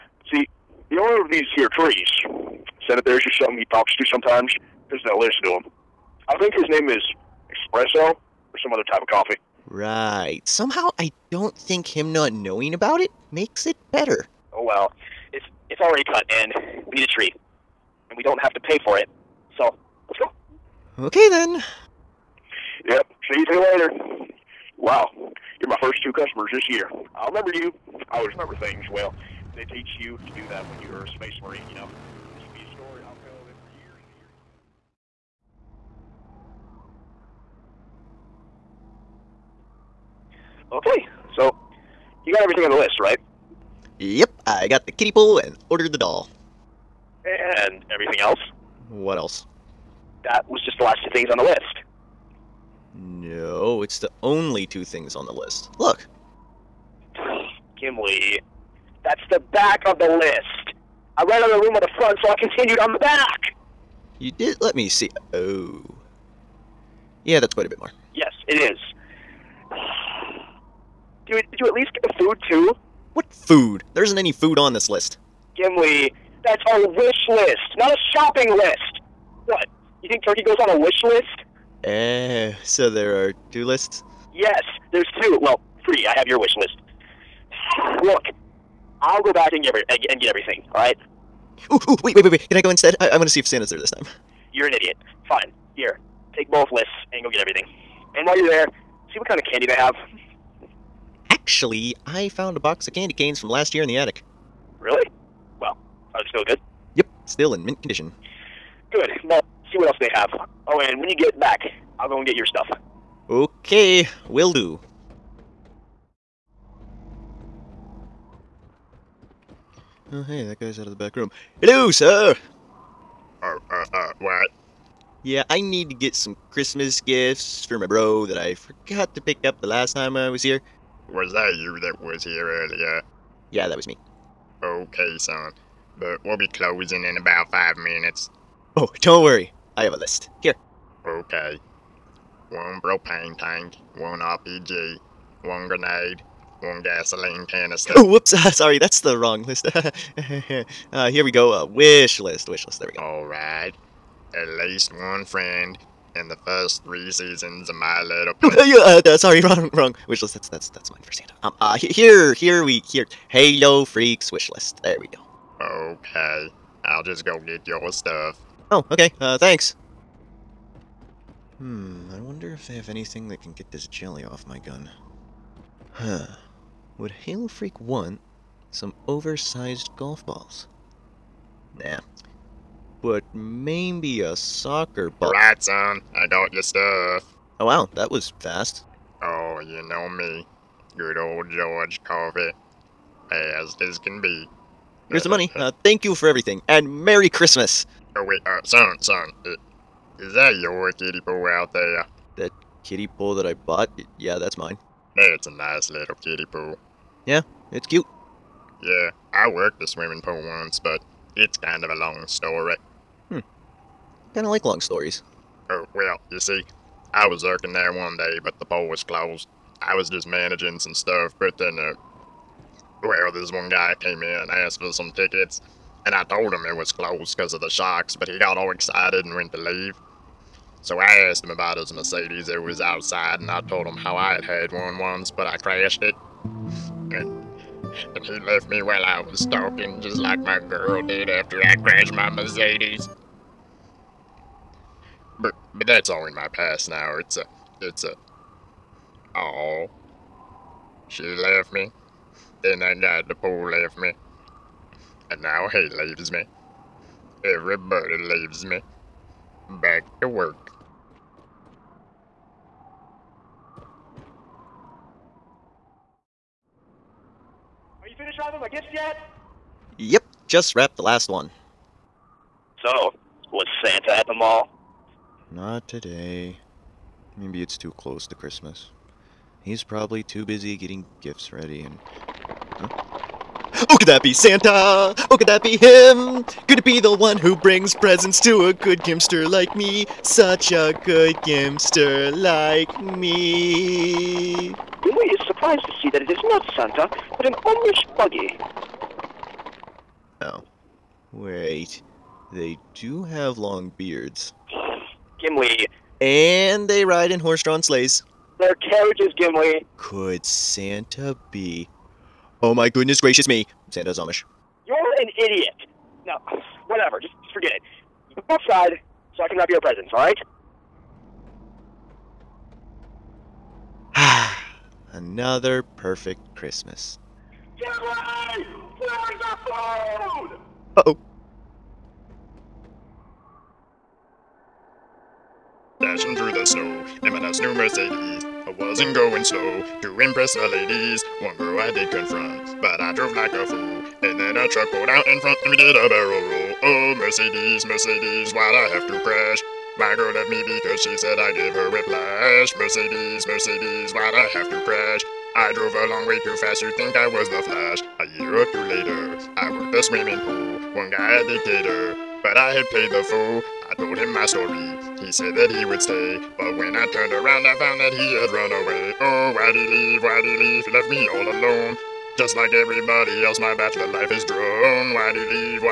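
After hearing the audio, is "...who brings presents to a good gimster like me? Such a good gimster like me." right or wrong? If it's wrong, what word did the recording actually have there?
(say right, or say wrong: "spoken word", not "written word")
right.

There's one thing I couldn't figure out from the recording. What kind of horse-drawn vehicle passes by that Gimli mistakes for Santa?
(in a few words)
Amish buggy.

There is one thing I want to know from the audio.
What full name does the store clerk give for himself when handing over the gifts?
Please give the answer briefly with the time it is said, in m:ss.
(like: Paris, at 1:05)
George Coffey, at 3:11.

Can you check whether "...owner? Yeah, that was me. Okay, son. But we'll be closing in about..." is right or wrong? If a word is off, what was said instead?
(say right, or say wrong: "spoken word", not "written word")
wrong: "earlier", not "owner".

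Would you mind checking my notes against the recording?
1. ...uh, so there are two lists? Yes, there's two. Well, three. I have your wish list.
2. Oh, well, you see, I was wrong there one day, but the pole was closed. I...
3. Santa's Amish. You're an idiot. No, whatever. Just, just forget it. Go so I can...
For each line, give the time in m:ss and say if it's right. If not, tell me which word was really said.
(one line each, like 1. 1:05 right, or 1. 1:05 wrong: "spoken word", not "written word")
1. 1:22 right
2. 3:35 wrong: "working", not "wrong"
3. 5:13 right.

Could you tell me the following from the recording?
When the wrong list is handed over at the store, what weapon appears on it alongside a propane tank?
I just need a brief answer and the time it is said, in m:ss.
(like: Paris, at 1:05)
RPG, at 2:24.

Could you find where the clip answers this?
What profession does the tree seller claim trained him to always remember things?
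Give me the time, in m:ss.
0:31.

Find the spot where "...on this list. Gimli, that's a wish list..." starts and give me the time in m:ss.
1:14.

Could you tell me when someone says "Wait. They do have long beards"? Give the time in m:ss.
5:01.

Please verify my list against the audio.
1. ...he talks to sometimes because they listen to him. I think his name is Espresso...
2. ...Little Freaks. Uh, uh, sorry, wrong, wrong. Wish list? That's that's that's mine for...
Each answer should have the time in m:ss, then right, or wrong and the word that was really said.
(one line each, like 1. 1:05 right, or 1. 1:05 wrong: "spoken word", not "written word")
1. 0:03 right
2. 2:38 wrong: "Pony", not "Freaks".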